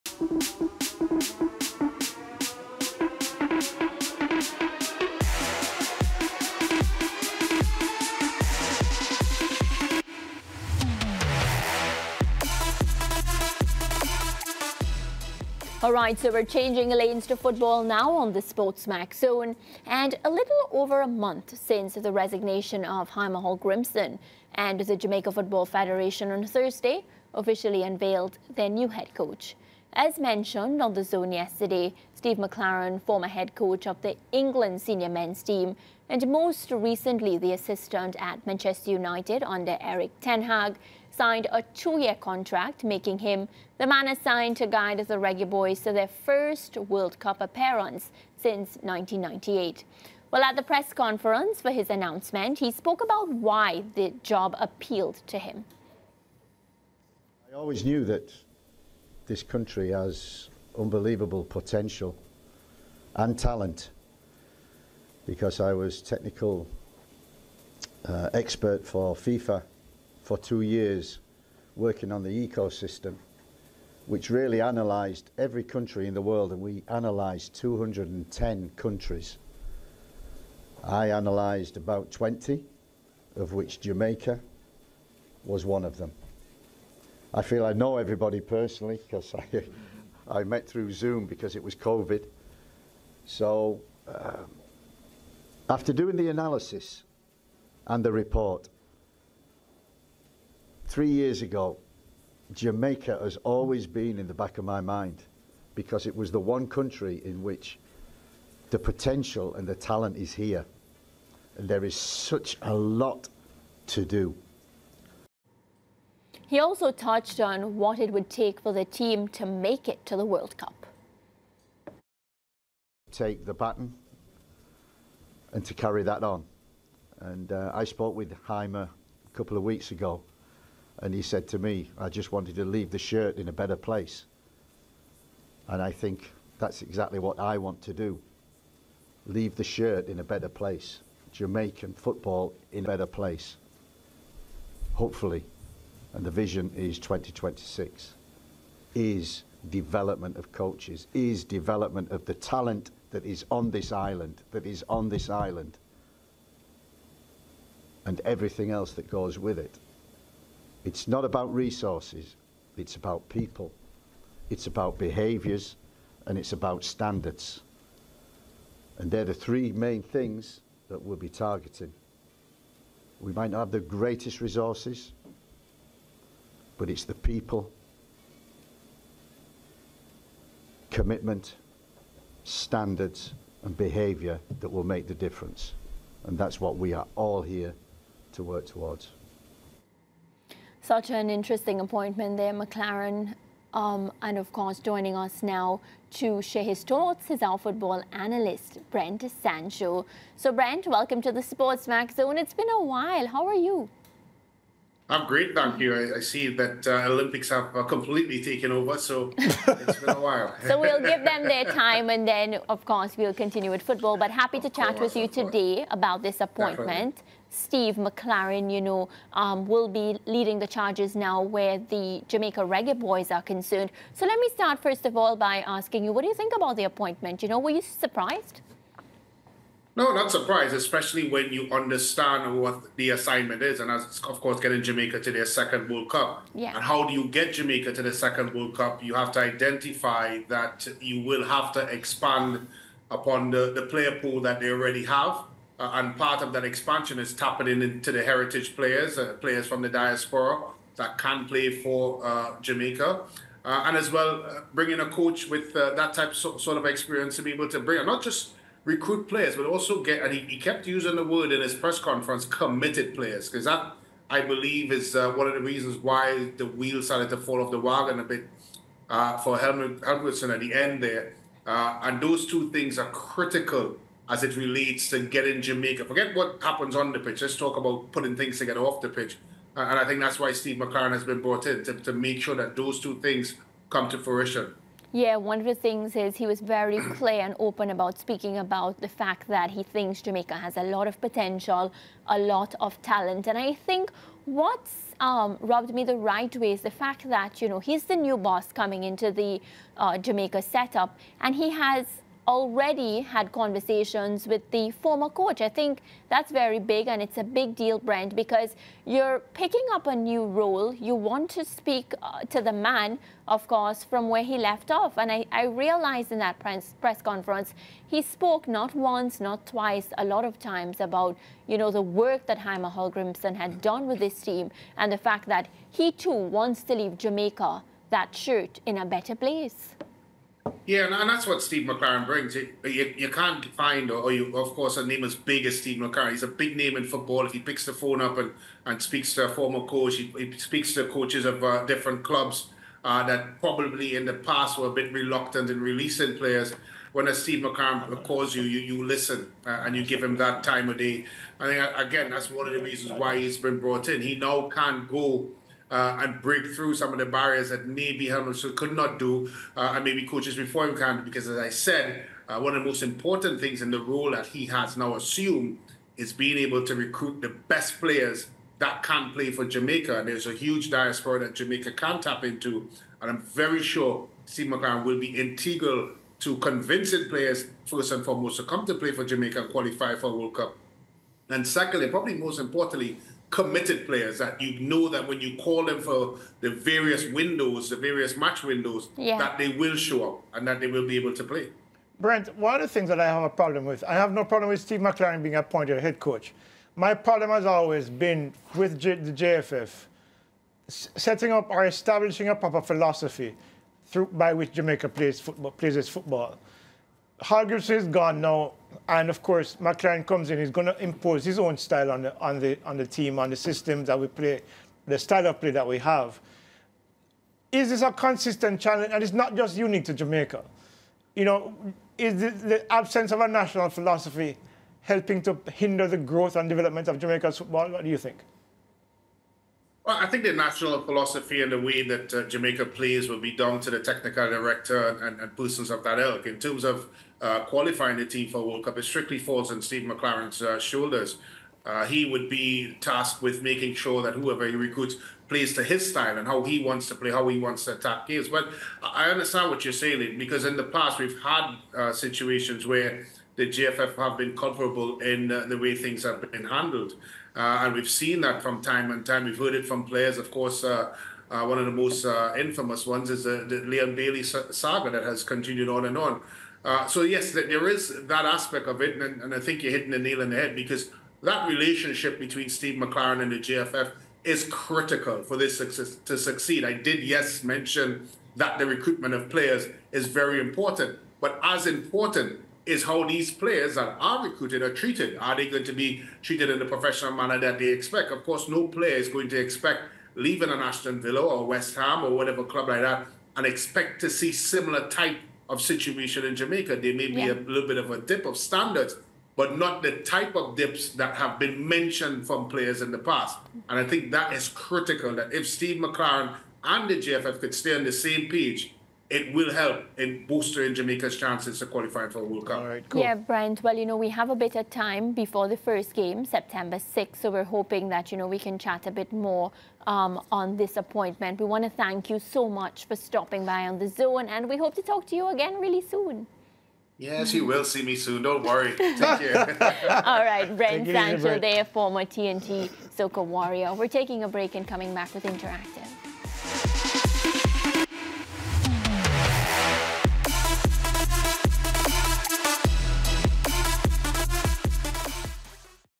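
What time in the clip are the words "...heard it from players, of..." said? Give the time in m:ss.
7:39.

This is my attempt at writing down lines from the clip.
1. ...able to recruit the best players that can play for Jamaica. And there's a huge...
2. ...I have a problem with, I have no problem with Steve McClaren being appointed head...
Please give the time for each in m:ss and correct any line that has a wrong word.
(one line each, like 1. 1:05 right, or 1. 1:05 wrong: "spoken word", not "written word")
1. 6:06 right
2. 6:33 right.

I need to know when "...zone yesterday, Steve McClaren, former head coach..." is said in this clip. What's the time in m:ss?
0:31.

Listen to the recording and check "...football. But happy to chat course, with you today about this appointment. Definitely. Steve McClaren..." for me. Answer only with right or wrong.
right.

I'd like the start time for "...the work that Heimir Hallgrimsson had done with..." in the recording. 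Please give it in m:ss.
5:21.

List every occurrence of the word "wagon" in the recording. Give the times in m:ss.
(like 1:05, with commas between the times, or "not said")
4:27.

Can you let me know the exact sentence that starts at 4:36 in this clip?
Forget what happens on the pitch.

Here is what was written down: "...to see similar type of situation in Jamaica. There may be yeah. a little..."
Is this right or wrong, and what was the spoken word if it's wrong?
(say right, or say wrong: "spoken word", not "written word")
right.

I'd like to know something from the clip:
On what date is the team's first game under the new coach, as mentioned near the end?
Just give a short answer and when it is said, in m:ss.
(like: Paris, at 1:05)
September 6, at 8:36.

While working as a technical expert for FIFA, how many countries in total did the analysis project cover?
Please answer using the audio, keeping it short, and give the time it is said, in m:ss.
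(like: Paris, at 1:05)
210, at 1:17.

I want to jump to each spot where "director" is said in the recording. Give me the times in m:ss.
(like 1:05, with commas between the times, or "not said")
7:14.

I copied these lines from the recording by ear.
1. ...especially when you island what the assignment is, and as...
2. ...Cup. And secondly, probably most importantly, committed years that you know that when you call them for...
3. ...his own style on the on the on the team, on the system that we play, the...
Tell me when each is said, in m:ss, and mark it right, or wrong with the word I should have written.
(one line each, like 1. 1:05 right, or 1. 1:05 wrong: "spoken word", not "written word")
1. 3:50 wrong: "understand", not "island"
2. 6:20 wrong: "players", not "years"
3. 6:51 right.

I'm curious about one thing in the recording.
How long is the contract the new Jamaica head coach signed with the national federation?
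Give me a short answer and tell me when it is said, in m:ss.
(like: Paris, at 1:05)
Two years, at 0:41.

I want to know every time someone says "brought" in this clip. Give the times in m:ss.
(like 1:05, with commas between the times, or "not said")
4:41, 5:53.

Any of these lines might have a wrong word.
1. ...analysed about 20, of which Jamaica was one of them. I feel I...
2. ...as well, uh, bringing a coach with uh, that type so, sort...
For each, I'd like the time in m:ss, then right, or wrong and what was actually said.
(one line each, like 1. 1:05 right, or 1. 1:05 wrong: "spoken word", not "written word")
1. 1:21 right
2. 4:13 right.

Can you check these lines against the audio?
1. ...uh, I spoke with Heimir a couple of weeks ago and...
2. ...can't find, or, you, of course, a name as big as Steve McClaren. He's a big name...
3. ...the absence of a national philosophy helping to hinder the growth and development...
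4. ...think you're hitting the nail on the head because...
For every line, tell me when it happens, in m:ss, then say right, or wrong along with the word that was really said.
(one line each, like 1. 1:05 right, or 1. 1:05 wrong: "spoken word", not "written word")
1. 2:07 right
2. 5:33 right
3. 7:02 right
4. 7:49 right.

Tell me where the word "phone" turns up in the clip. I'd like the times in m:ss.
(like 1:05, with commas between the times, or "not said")
5:37.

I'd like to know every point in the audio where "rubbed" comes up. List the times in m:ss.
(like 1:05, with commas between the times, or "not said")
4:55.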